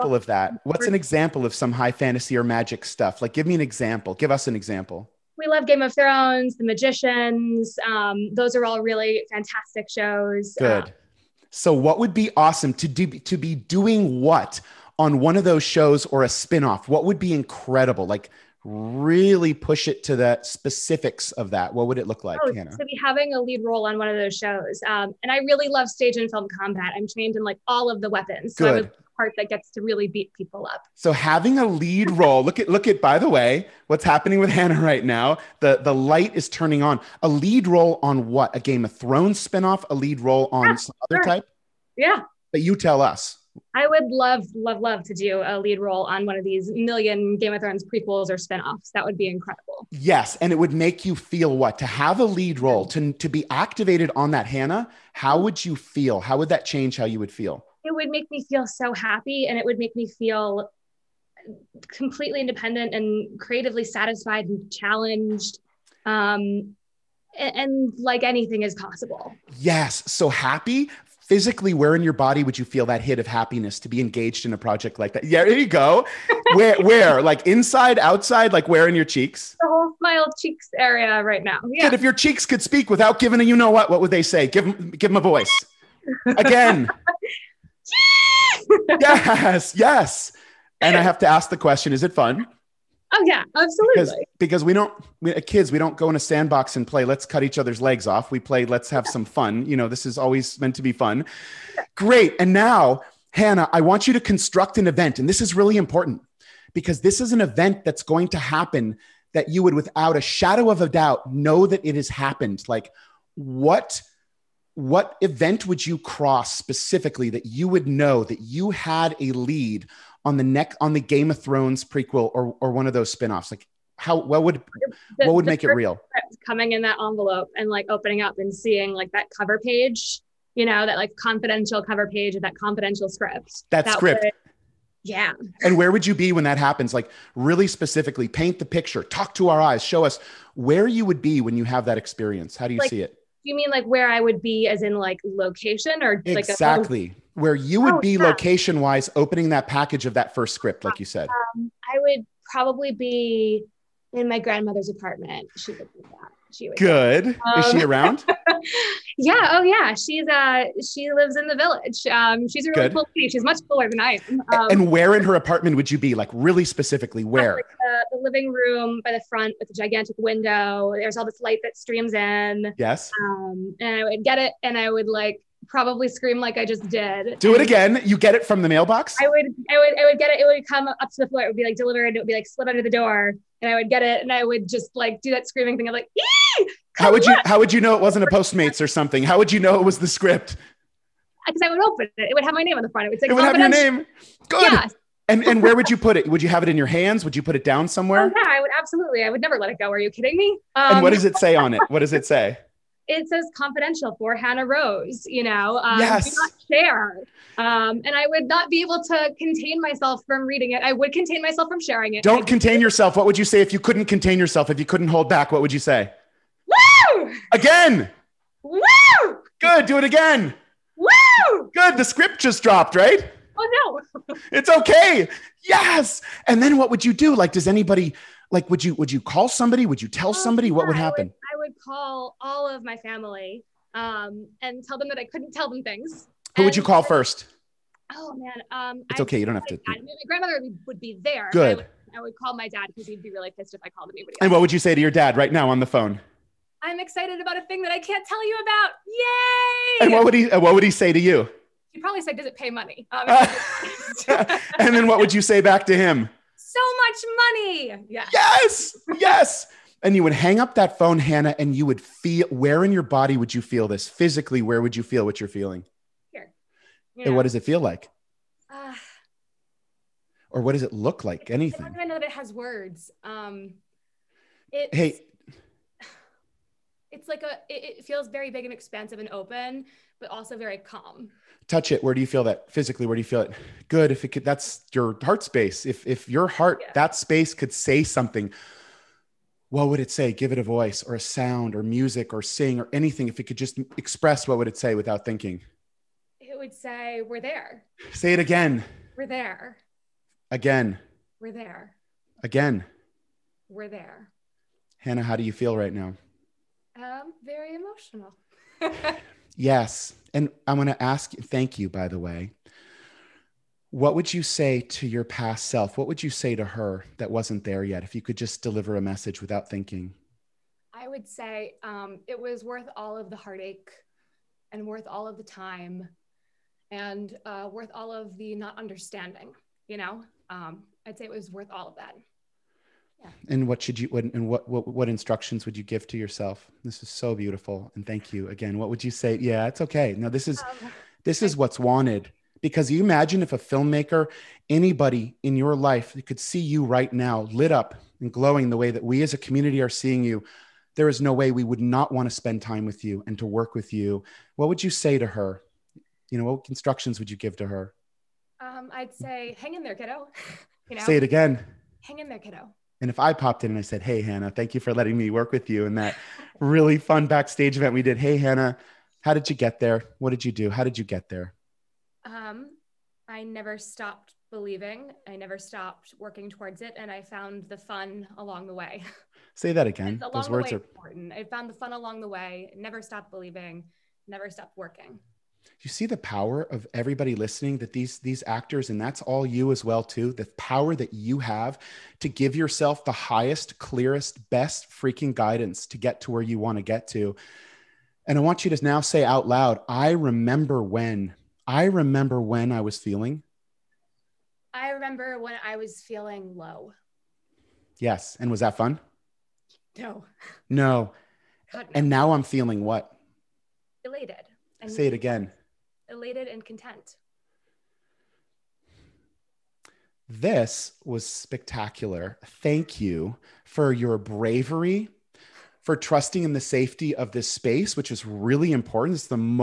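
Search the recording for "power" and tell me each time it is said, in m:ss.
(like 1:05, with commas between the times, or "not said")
6:26, 6:30.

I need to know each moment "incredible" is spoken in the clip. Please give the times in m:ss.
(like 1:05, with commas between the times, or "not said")
0:17, 0:49.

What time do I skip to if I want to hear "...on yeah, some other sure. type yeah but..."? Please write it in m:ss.
0:40.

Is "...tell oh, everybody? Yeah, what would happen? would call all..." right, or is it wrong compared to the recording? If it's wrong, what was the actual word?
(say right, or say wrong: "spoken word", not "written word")
wrong: "somebody", not "everybody".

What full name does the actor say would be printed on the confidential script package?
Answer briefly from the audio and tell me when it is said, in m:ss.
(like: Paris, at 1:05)
Hannah Rose, at 3:24.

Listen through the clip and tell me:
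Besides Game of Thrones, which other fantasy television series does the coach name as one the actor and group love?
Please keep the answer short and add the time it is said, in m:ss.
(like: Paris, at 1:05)
The Magicians, at 0:06.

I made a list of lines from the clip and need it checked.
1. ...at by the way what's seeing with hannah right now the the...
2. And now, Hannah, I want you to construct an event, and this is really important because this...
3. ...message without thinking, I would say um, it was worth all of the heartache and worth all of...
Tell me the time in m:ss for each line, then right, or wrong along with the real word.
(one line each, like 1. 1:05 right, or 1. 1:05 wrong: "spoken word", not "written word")
1. 0:32 wrong: "happening", not "seeing"
2. 1:42 right
3. 5:19 right.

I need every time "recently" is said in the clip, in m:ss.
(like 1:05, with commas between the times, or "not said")
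not said.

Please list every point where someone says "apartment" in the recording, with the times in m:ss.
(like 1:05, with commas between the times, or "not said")
2:34, 2:45.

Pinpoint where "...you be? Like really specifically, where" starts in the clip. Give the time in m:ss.
2:45.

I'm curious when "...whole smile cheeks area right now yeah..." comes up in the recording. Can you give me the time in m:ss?
1:19.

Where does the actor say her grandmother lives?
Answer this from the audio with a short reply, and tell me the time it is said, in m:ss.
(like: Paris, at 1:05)
The village, at 2:41.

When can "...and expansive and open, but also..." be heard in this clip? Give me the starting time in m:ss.
4:38.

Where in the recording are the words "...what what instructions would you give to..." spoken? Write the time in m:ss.
5:34.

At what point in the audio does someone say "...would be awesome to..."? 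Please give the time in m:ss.
0:11.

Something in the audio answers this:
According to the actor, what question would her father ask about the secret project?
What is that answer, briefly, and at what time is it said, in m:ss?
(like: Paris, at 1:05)
Does it pay money?, at 4:12.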